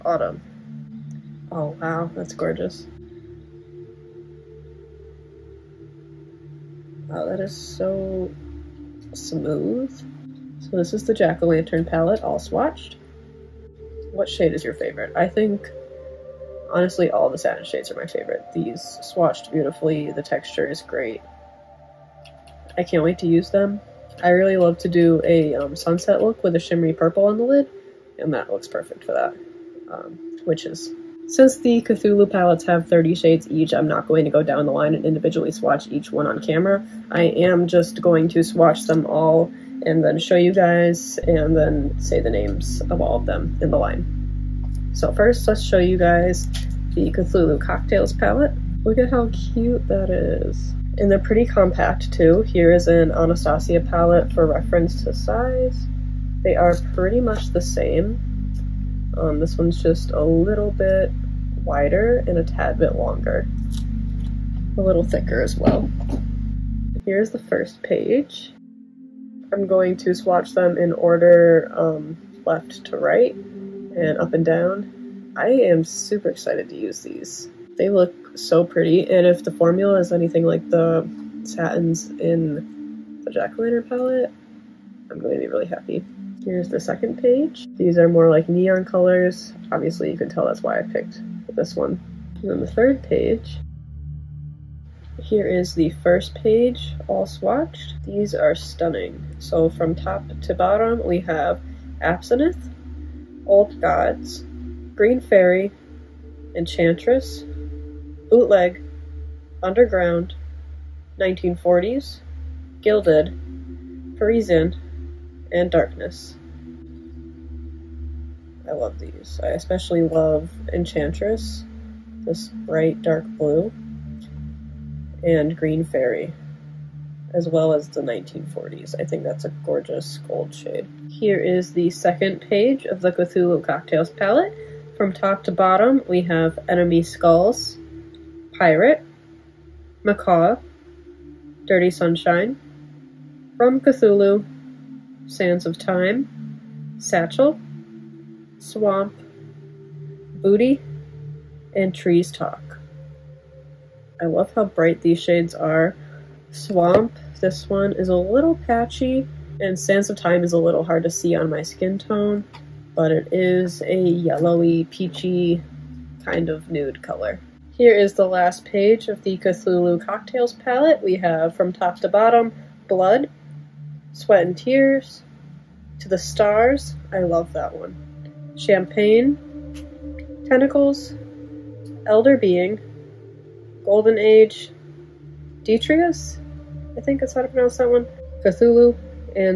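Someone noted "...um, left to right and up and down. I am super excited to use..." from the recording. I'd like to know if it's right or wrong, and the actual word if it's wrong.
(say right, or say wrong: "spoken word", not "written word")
right.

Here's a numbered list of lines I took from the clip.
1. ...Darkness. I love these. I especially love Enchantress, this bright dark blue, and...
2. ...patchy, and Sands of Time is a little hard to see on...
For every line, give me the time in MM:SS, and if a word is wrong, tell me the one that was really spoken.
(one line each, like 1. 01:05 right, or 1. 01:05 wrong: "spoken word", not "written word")
1. 01:55 right
2. 02:38 right.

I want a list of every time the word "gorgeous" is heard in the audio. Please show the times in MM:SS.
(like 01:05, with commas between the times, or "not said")
00:02, 02:09.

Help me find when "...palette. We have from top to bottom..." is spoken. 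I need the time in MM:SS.
02:50.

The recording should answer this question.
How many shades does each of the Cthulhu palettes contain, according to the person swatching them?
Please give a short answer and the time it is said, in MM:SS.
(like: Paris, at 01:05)
30, at 00:32.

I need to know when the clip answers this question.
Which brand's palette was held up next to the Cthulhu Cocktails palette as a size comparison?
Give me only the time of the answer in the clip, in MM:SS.
00:53.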